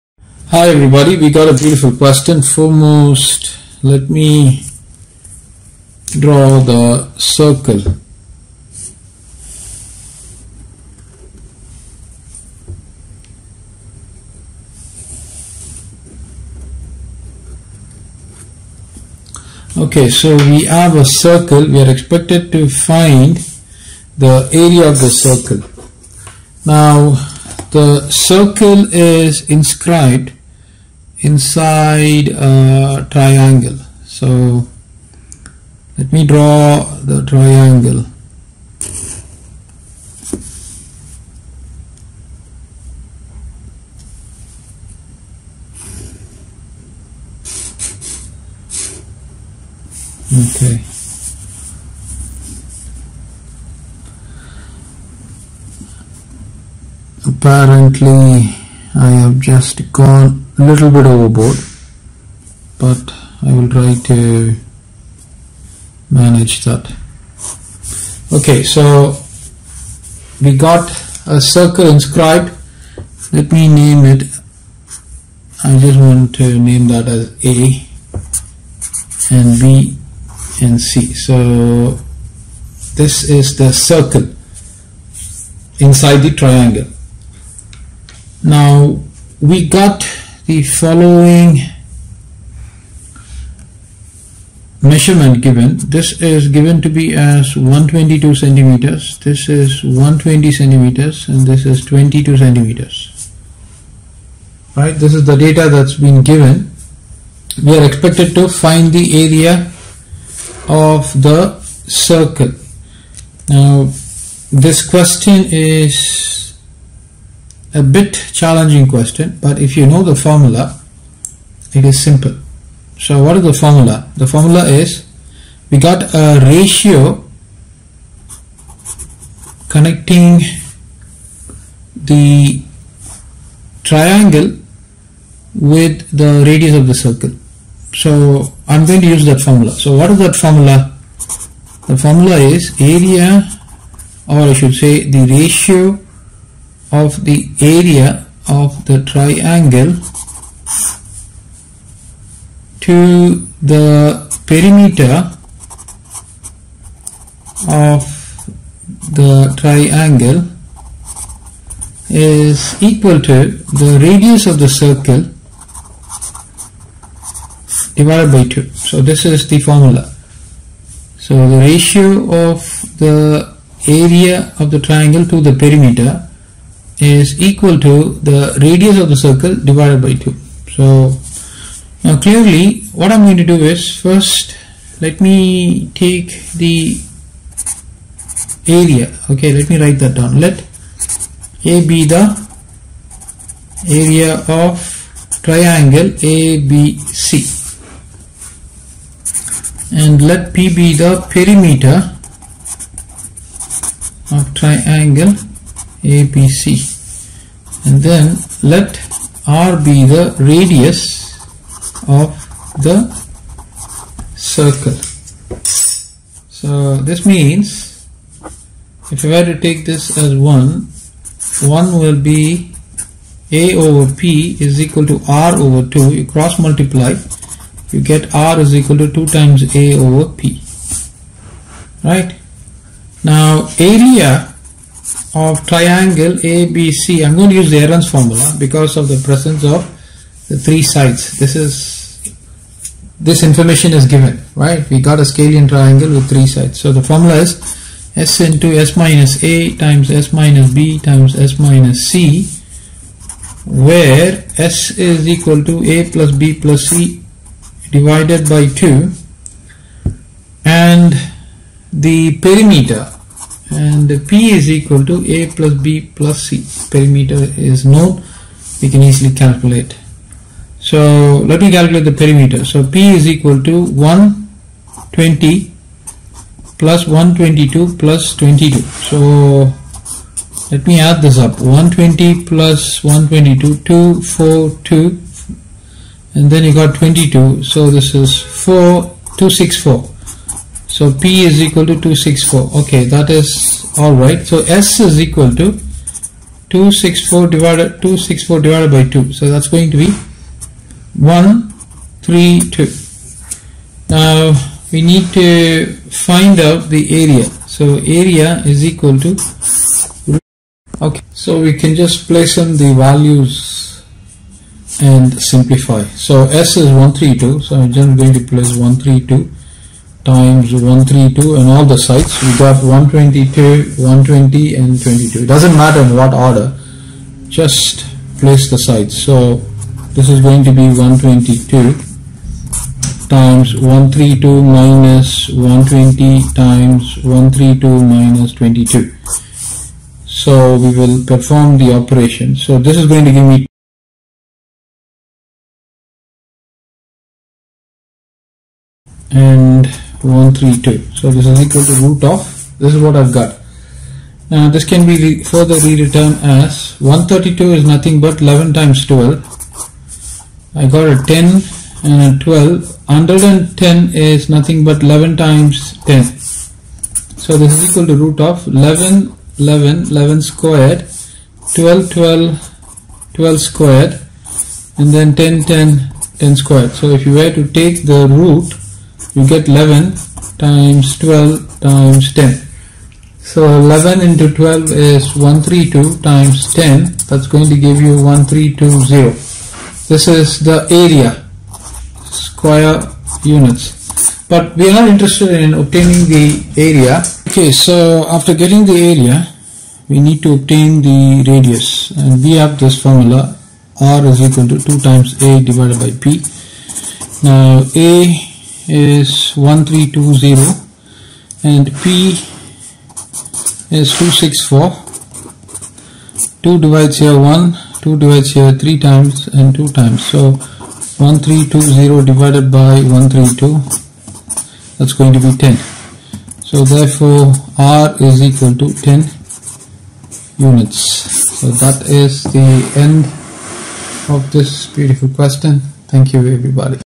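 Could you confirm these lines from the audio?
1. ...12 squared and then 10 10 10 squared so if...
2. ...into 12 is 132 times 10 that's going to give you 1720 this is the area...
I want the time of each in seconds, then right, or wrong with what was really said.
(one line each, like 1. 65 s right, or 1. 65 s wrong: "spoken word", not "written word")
1. 373 s right
2. 384 s wrong: "1320", not "1720".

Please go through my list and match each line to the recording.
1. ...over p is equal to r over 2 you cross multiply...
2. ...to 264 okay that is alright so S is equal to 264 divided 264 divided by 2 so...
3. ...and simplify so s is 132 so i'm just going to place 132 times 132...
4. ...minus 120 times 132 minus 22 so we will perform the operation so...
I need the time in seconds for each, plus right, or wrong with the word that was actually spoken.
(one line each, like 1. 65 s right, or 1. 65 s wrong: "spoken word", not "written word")
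1. 223 s right
2. 291 s right
3. 315 s right
4. 334 s right.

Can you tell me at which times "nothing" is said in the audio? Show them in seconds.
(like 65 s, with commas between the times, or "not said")
357 s, 364 s.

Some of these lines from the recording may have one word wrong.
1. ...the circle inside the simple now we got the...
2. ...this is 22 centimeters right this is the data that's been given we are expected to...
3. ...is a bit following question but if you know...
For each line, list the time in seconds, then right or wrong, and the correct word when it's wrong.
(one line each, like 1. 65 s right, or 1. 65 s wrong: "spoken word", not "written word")
1. 83 s wrong: "triangle", not "simple"
2. 101 s right
3. 115 s wrong: "challenging", not "following".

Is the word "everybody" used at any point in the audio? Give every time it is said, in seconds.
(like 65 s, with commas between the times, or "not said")
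0 s, 436 s.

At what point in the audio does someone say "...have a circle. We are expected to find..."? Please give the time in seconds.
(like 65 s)
20 s.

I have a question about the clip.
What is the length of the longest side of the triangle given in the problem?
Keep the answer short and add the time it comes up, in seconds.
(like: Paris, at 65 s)
122 centimeters, at 97 s.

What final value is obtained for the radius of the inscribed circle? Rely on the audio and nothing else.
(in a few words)
10 units.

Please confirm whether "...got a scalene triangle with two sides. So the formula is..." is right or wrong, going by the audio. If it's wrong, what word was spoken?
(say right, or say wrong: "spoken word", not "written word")
wrong: "three", not "two".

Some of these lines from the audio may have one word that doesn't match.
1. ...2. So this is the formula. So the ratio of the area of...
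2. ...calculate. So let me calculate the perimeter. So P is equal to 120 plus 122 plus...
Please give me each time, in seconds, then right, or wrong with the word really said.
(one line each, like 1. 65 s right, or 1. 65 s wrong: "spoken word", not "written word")
1. 168 s right
2. 269 s right.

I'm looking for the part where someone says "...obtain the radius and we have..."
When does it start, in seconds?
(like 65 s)
400 s.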